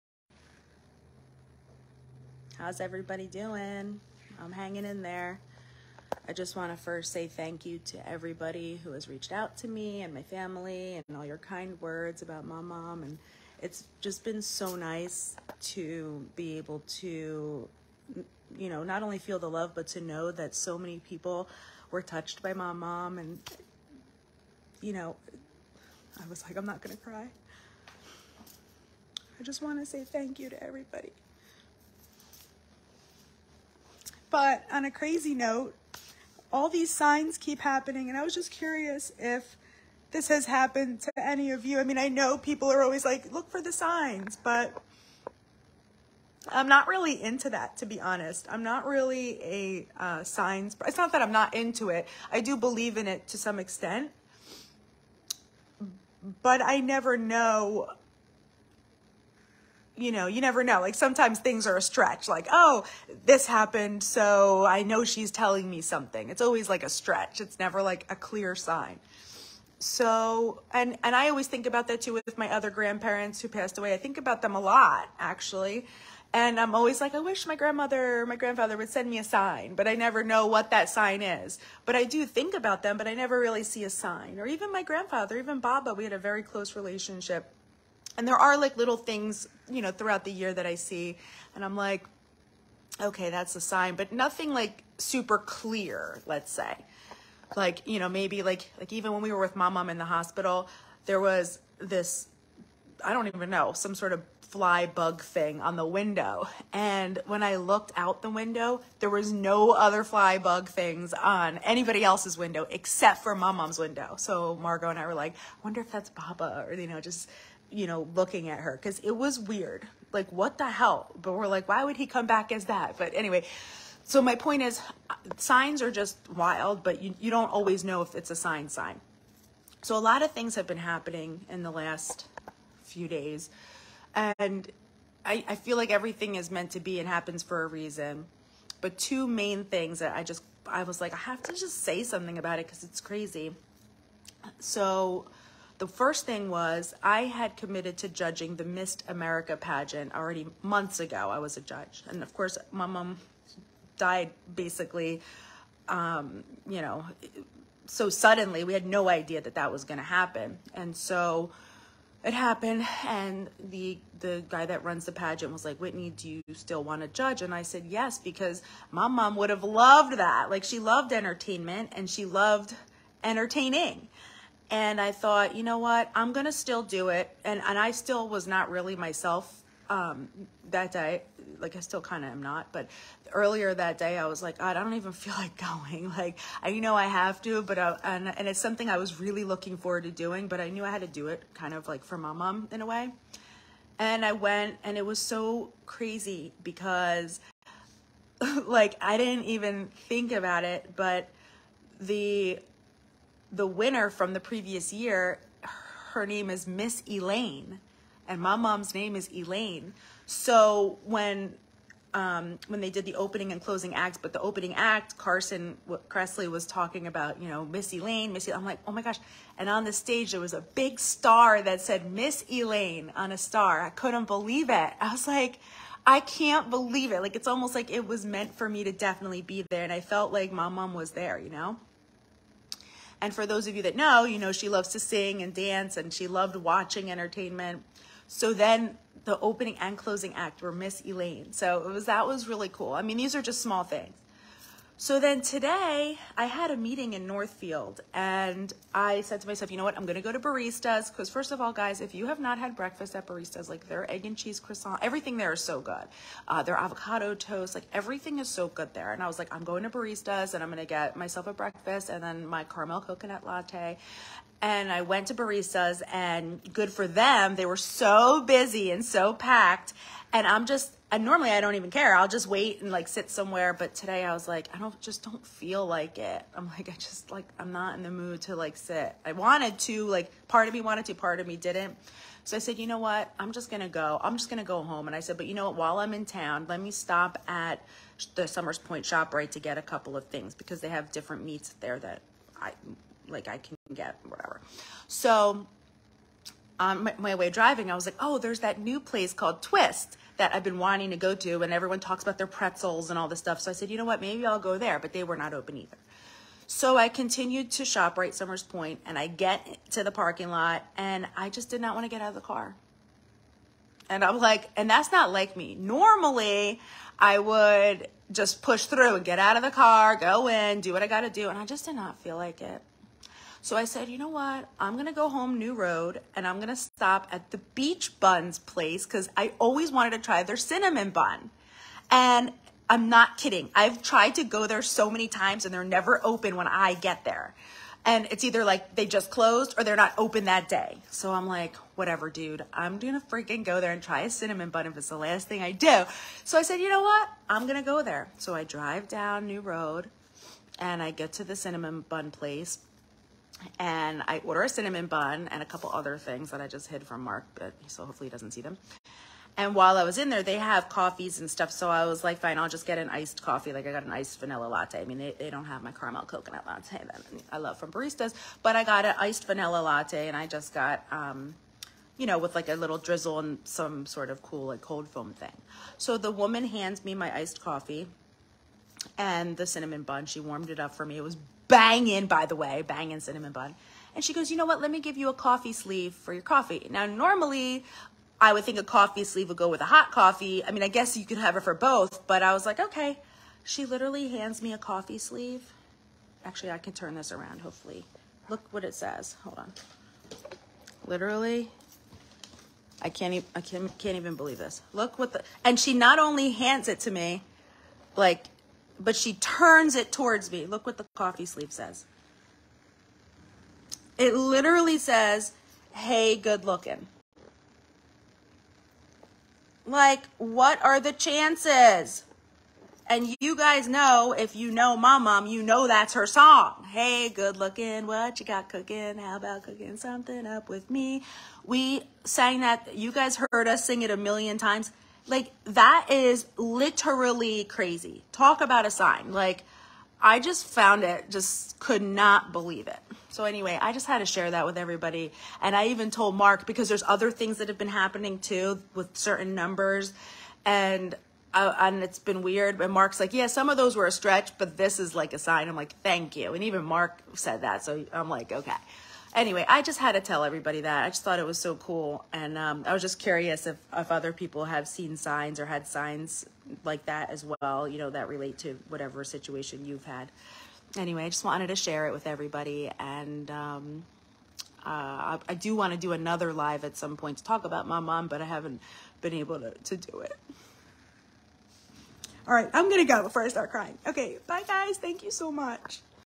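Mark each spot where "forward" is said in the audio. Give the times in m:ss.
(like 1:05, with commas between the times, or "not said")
3:09.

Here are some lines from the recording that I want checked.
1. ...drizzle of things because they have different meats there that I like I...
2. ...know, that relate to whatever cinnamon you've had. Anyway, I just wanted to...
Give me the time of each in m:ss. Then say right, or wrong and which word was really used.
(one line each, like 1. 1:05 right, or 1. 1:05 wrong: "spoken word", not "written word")
1. 4:49 wrong: "couple", not "drizzle"
2. 7:47 wrong: "situation", not "cinnamon".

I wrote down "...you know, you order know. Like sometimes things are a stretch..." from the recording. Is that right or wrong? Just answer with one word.
wrong.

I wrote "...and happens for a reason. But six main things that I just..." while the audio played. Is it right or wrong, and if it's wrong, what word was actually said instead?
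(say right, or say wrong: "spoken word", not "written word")
wrong: "two", not "six".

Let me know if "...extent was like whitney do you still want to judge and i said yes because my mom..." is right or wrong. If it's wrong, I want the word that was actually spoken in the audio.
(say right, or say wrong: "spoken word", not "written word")
wrong: "pageant", not "extent".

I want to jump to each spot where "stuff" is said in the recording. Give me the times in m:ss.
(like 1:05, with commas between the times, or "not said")
5:03, 6:01.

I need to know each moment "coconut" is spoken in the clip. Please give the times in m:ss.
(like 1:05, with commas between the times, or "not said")
4:23, 6:06.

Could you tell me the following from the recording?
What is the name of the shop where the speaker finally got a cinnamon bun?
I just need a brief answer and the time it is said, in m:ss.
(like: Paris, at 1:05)
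Beach Buns, at 5:27.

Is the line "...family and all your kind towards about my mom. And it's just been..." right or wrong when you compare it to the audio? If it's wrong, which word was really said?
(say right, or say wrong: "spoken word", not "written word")
wrong: "words", not "towards".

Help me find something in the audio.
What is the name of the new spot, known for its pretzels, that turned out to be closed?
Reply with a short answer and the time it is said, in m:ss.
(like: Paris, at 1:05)
Twist, at 4:59.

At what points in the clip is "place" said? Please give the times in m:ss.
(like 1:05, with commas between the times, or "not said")
4:58, 5:28, 5:52.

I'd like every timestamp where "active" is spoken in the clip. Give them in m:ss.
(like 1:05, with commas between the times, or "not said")
not said.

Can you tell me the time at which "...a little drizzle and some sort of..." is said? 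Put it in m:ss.
6:12.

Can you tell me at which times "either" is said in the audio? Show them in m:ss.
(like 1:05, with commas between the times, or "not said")
5:05, 5:38.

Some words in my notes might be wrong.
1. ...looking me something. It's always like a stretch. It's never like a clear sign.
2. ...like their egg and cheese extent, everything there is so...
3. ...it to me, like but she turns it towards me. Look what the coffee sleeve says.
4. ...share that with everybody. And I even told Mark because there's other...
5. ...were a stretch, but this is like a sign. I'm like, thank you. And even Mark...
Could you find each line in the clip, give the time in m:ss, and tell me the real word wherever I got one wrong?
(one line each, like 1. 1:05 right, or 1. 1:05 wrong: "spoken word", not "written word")
1. 1:05 wrong: "telling", not "looking"
2. 4:13 wrong: "croissant", not "extent"
3. 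6:46 right
4. 7:24 right
5. 7:33 right.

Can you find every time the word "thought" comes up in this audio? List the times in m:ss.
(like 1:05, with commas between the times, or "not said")
2:55, 7:41.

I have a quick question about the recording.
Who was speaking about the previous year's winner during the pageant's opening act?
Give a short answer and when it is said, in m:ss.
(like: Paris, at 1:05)
Carson Kressley, at 3:35.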